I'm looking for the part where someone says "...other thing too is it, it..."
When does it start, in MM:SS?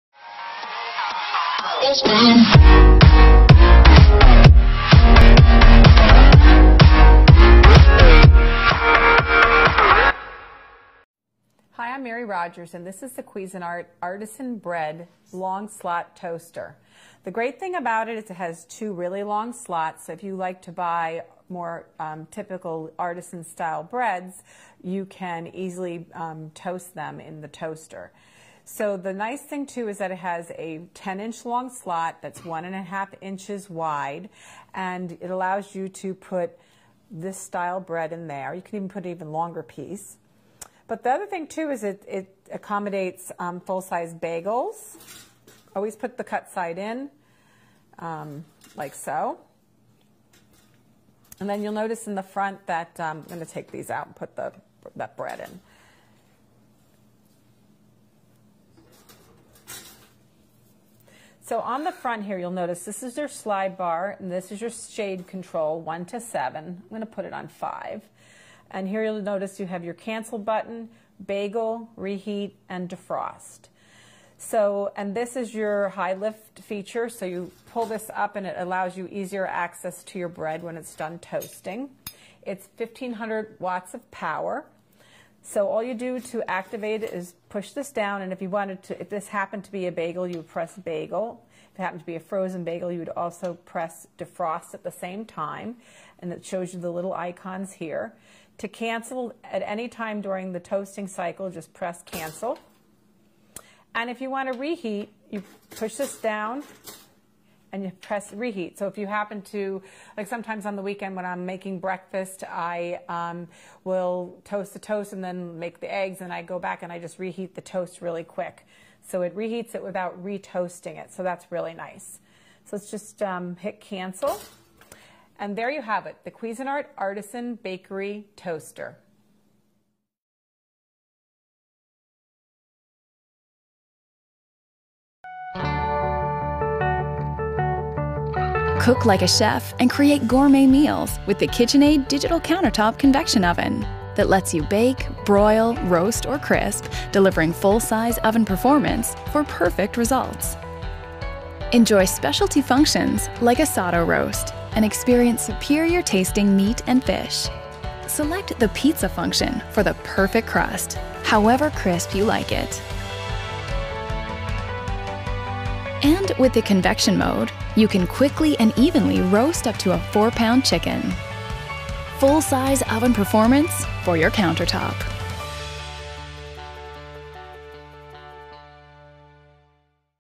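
00:41.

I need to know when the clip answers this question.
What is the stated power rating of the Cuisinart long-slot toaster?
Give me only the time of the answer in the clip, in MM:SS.
01:22.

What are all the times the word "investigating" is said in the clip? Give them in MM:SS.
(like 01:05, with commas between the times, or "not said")
not said.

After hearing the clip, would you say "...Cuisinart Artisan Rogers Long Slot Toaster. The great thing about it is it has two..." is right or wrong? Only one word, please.
wrong.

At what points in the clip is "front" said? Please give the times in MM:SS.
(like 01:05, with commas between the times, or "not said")
00:52, 01:01.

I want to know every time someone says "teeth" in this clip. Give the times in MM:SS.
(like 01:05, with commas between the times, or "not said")
not said.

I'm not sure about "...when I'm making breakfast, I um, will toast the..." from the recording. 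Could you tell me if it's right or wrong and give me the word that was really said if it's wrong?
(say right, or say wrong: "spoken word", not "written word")
right.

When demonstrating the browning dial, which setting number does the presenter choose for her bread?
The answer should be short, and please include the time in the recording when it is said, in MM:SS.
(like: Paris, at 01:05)
5, at 01:07.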